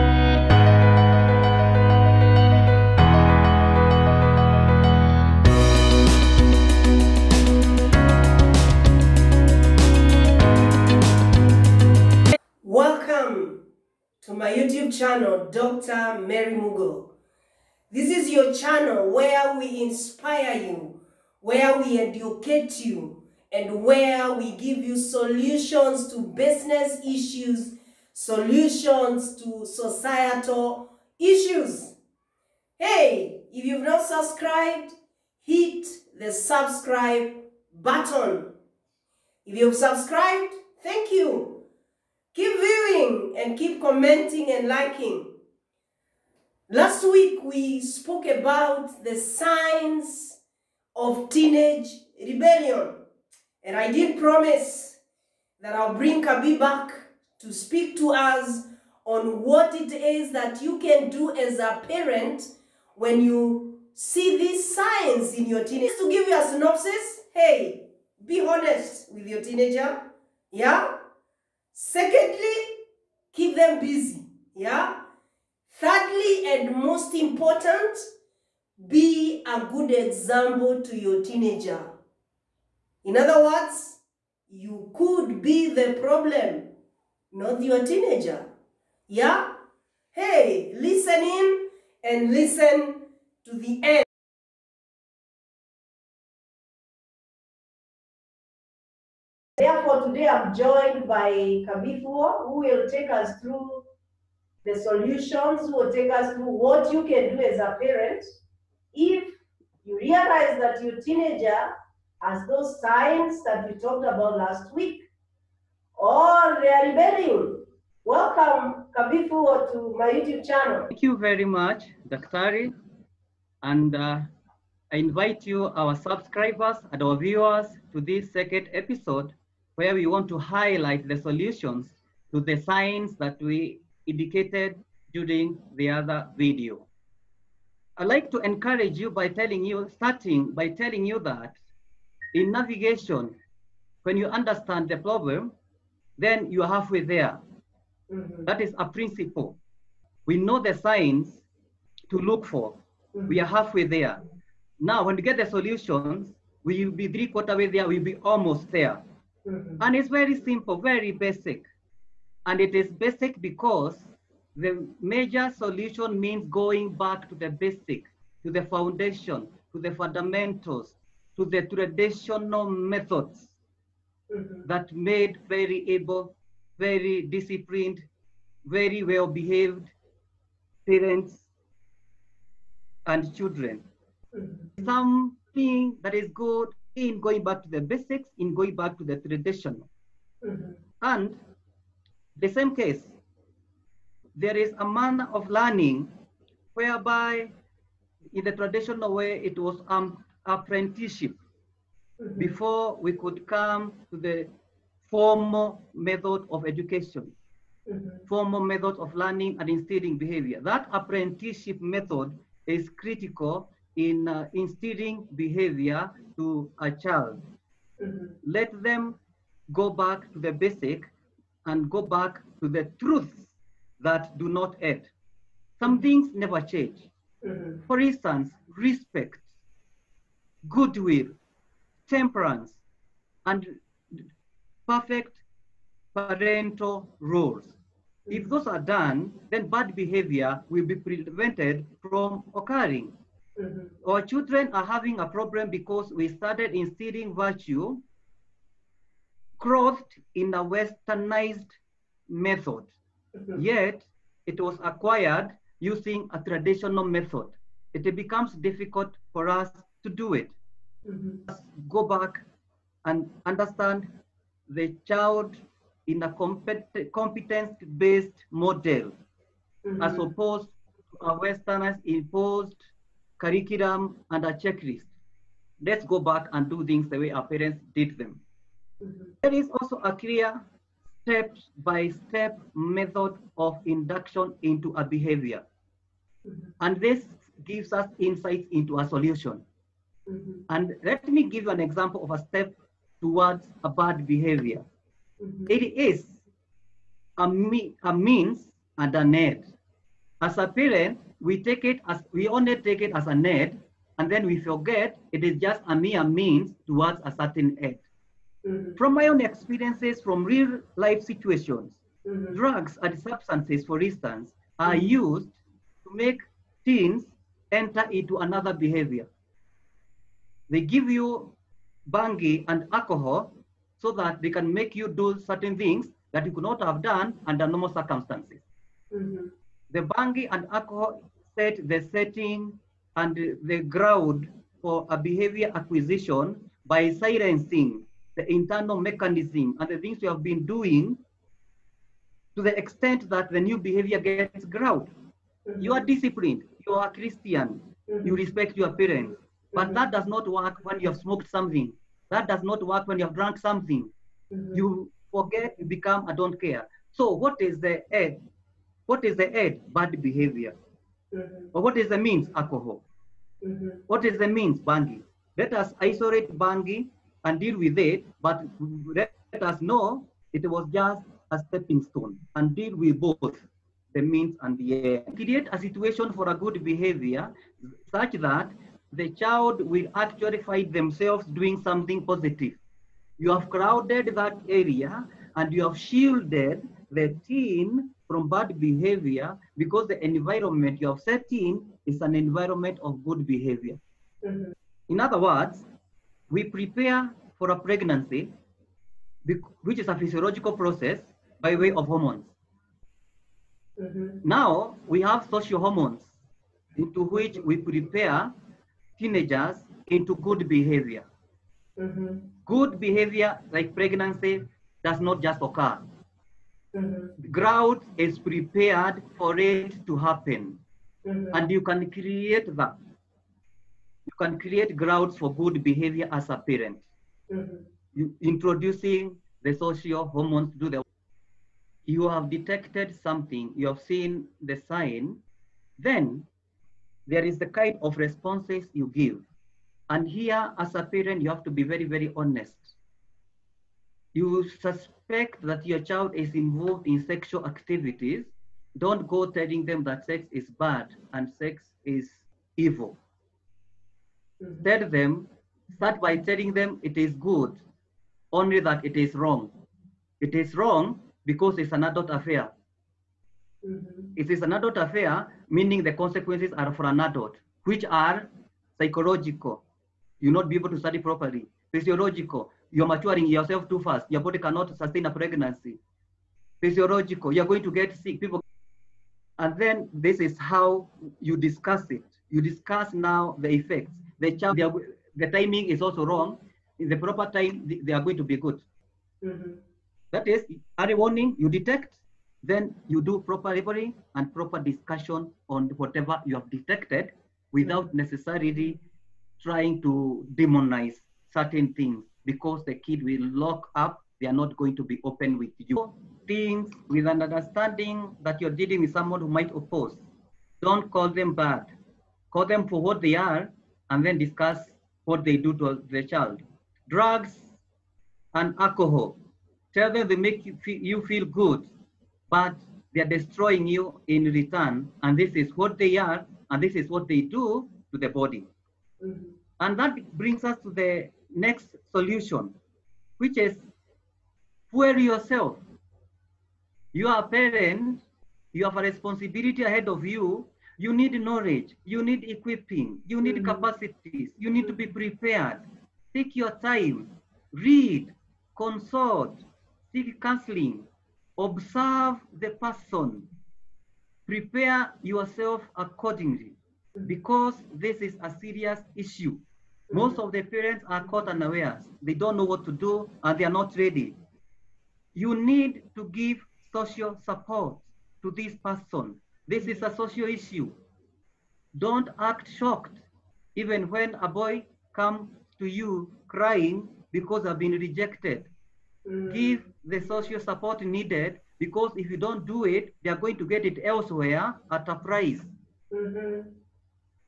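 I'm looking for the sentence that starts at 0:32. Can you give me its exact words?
Hey, if you've not subscribed, hit the subscribe button.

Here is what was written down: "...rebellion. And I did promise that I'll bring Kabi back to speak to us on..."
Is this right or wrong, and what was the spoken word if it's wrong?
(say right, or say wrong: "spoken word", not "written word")
right.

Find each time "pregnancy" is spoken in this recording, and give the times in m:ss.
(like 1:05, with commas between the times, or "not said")
6:37, 6:53, 7:55.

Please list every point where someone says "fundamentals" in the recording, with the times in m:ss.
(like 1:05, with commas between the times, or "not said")
2:49.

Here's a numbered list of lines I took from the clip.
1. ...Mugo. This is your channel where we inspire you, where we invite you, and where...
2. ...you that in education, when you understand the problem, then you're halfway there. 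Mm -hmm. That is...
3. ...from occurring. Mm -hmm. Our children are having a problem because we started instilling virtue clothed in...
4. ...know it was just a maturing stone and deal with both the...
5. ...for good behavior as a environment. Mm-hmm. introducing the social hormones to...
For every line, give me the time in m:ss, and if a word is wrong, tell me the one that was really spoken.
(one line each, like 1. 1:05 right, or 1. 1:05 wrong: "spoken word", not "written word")
1. 0:16 wrong: "educate", not "invite"
2. 2:21 wrong: "navigation", not "education"
3. 4:02 right
4. 6:09 wrong: "stepping", not "maturing"
5. 7:05 wrong: "parent", not "environment".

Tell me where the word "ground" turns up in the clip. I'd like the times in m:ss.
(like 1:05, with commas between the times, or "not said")
5:33, 5:44, 6:57, 7:04.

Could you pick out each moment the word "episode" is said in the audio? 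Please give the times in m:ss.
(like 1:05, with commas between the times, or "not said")
2:08.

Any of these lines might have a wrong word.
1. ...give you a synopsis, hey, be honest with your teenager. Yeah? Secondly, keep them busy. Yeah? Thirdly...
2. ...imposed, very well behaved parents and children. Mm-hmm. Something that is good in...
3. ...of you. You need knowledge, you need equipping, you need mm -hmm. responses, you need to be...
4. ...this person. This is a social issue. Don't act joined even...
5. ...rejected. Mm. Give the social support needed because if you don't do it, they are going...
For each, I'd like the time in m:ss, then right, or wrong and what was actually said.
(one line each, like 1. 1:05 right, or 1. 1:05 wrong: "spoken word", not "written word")
1. 1:06 right
2. 2:57 wrong: "disciplined", not "imposed"
3. 9:00 wrong: "capacities", not "responses"
4. 9:28 wrong: "shocked", not "joined"
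5. 9:37 right.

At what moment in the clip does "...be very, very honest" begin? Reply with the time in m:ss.
7:21.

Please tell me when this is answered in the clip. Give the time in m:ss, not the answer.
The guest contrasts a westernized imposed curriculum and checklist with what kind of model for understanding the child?
4:27.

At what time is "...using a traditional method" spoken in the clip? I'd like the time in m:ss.
4:15.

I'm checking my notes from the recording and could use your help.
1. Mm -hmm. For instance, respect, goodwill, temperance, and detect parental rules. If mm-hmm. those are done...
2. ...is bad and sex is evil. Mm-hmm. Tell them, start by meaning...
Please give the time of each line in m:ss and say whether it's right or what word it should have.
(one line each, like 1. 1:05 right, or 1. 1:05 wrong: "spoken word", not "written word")
1. 3:47 wrong: "perfect", not "detect"
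2. 7:30 wrong: "telling", not "meaning".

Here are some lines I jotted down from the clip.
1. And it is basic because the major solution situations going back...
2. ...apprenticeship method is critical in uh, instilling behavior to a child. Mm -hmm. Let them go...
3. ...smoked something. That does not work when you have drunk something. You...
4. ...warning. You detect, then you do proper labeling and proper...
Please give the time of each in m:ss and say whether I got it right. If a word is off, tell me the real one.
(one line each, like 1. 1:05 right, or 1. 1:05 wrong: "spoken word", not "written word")
1. 2:42 wrong: "means", not "situations"
2. 3:30 right
3. 5:51 right
4. 8:11 right.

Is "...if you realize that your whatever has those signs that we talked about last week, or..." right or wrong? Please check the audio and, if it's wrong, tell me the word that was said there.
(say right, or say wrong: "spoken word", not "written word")
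wrong: "teenager", not "whatever".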